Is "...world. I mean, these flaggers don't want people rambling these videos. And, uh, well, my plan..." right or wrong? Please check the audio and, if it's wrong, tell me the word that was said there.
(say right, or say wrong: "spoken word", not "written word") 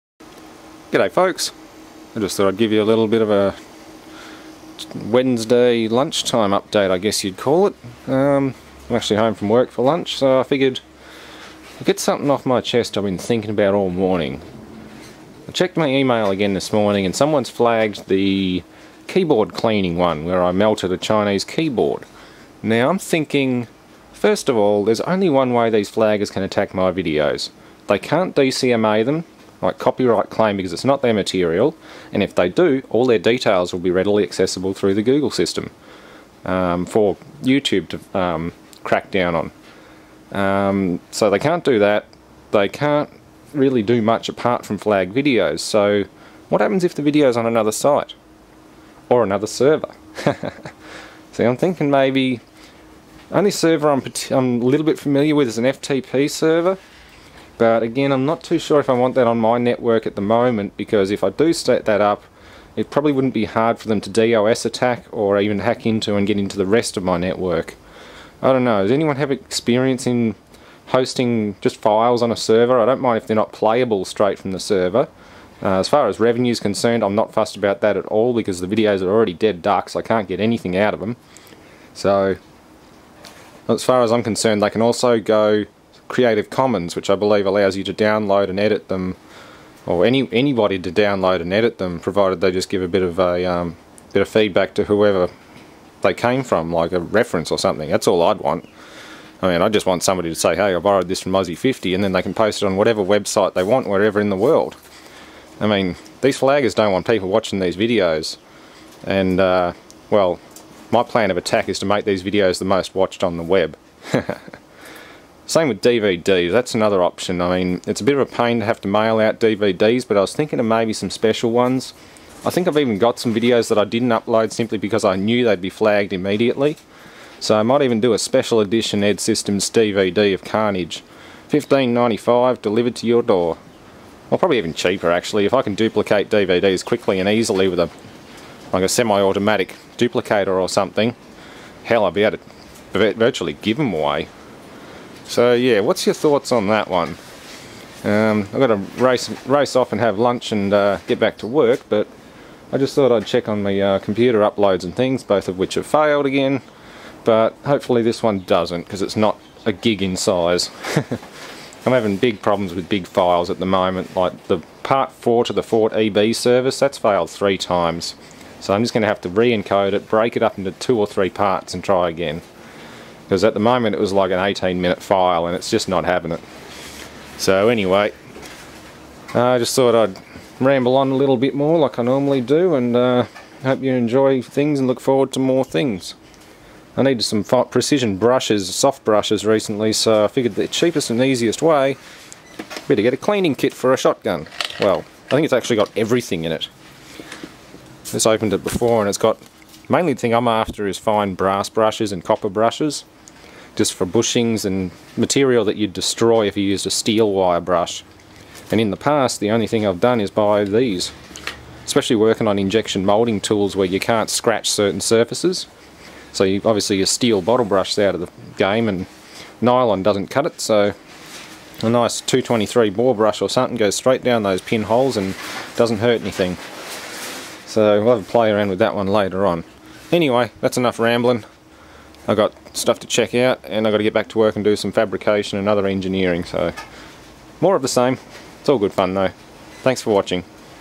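wrong: "watching", not "rambling".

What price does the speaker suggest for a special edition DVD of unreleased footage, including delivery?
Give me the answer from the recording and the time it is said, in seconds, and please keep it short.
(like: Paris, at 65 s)
$15.95, at 131 s.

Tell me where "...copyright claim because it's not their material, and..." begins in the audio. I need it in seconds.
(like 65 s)
29 s.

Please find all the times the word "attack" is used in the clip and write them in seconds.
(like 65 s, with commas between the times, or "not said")
26 s, 64 s, 111 s.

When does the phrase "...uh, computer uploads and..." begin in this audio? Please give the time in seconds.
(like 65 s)
153 s.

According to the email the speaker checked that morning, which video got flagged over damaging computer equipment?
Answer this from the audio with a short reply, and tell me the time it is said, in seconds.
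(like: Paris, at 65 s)
Keyboard cleaning, at 19 s.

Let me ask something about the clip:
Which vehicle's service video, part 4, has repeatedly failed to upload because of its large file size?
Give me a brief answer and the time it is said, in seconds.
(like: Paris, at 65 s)
Ford EB, at 165 s.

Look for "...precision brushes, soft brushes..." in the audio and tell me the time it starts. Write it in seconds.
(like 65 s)
187 s.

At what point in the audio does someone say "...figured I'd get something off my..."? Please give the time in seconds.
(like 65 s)
10 s.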